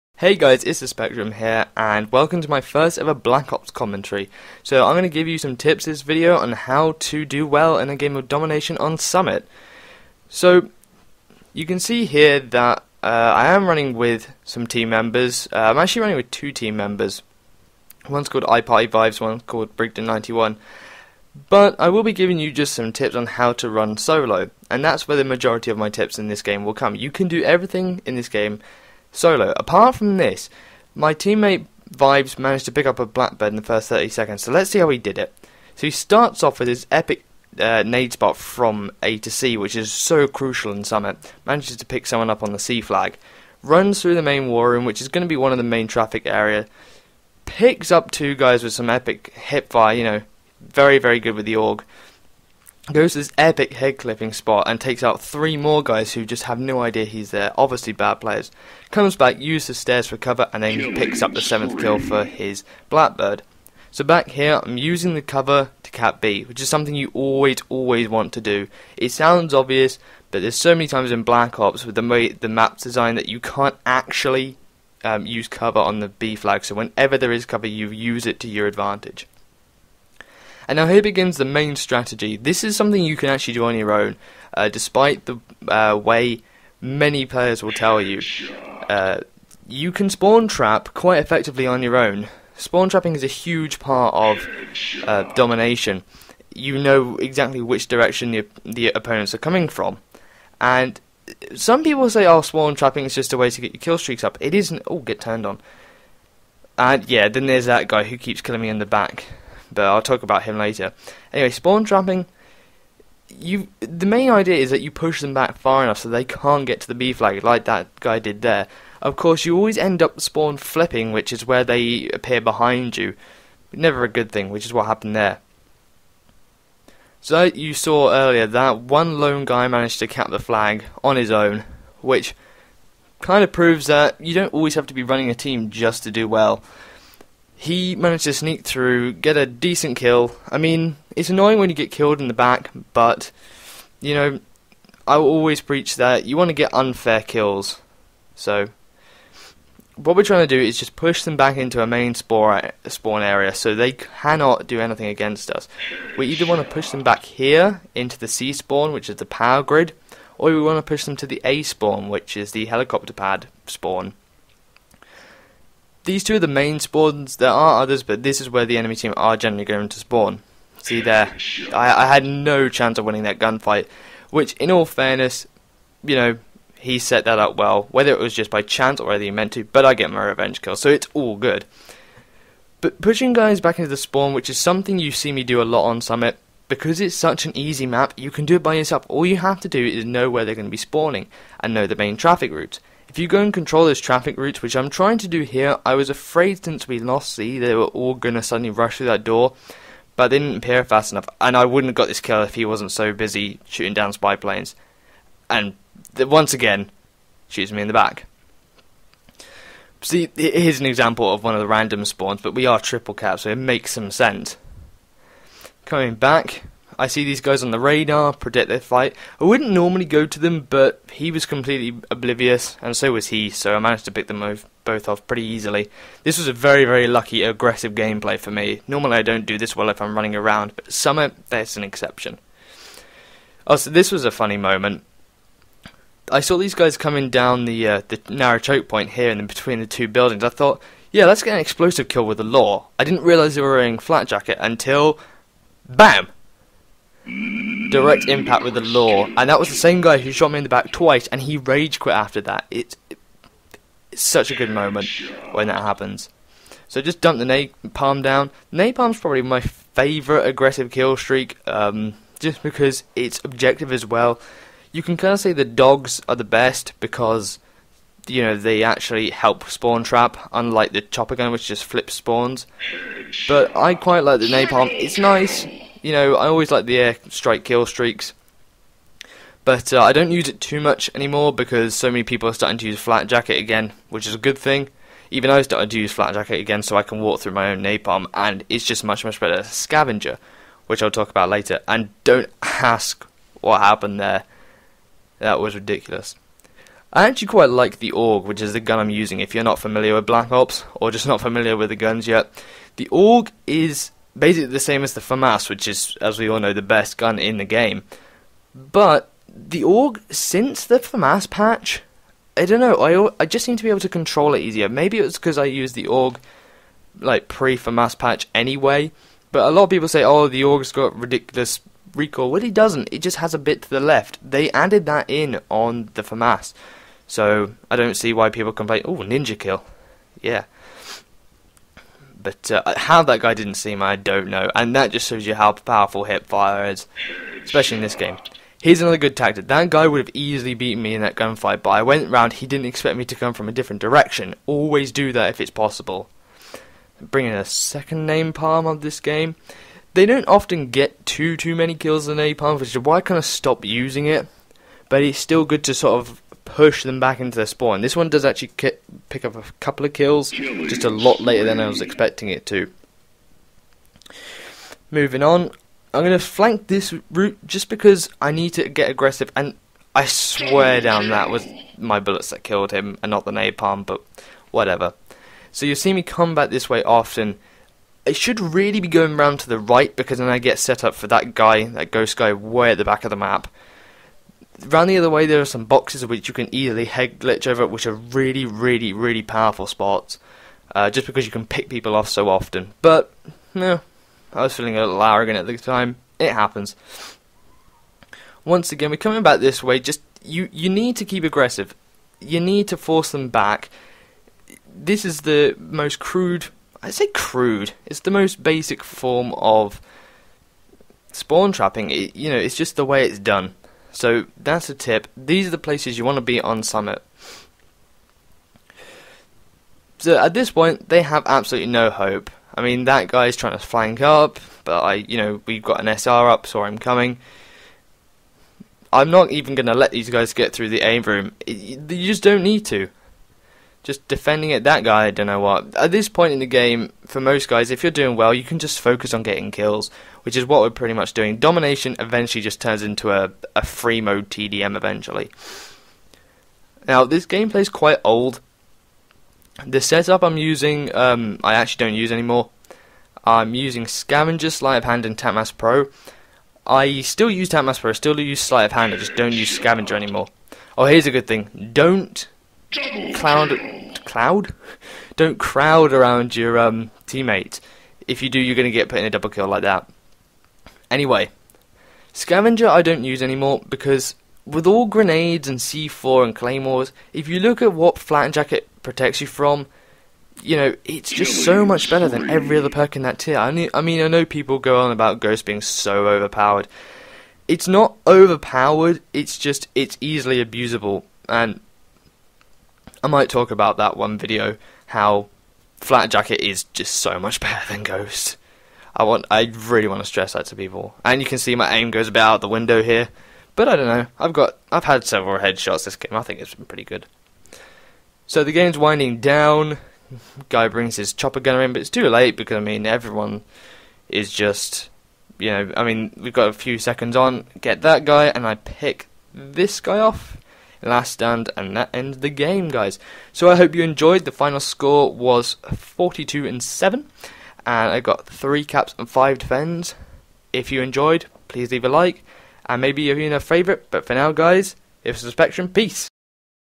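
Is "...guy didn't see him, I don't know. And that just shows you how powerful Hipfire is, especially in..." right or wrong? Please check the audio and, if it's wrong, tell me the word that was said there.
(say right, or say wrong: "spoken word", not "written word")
right.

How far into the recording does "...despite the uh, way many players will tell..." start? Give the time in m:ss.
1:24.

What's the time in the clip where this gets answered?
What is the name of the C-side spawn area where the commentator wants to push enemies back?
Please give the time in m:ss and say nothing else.
2:39.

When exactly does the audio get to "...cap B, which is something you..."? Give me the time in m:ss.
1:05.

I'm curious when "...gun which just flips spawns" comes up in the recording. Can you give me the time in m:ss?
4:31.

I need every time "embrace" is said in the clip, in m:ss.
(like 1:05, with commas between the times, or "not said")
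not said.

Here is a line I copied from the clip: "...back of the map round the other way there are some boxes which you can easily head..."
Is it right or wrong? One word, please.
right.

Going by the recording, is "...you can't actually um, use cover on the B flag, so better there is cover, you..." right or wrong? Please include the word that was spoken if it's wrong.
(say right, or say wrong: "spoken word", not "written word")
wrong: "whenever", not "better".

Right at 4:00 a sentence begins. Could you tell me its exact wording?
I thought, yeah, let's get an explosive kill with the law.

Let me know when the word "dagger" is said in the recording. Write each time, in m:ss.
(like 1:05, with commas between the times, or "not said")
not said.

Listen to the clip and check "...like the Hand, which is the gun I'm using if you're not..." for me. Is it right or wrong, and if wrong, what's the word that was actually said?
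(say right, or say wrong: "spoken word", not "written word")
wrong: "AUG", not "Hand".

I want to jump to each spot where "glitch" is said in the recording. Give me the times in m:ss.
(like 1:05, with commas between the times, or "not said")
6:27.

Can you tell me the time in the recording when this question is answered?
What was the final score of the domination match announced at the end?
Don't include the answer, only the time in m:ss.
8:45.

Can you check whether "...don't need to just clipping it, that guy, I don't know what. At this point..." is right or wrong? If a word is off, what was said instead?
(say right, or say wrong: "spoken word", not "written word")
wrong: "defending", not "clipping".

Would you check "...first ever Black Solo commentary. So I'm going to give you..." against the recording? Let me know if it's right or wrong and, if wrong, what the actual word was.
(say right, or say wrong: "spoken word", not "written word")
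wrong: "Ops", not "Solo".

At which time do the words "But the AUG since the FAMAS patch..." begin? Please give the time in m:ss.
5:08.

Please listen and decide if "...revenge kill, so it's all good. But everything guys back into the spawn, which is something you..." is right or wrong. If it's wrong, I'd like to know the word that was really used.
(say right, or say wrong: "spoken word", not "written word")
wrong: "pushing", not "everything".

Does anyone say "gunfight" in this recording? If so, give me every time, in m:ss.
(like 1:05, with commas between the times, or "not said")
2:53, 5:41.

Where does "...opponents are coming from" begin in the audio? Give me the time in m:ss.
1:38.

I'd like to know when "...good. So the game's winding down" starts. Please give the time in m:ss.
8:27.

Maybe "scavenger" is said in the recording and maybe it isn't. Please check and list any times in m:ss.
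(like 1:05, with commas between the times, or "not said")
4:49, 7:34, 7:39, 7:52.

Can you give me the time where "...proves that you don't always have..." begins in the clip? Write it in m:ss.
2:13.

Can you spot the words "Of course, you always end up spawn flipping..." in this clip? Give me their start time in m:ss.
1:59.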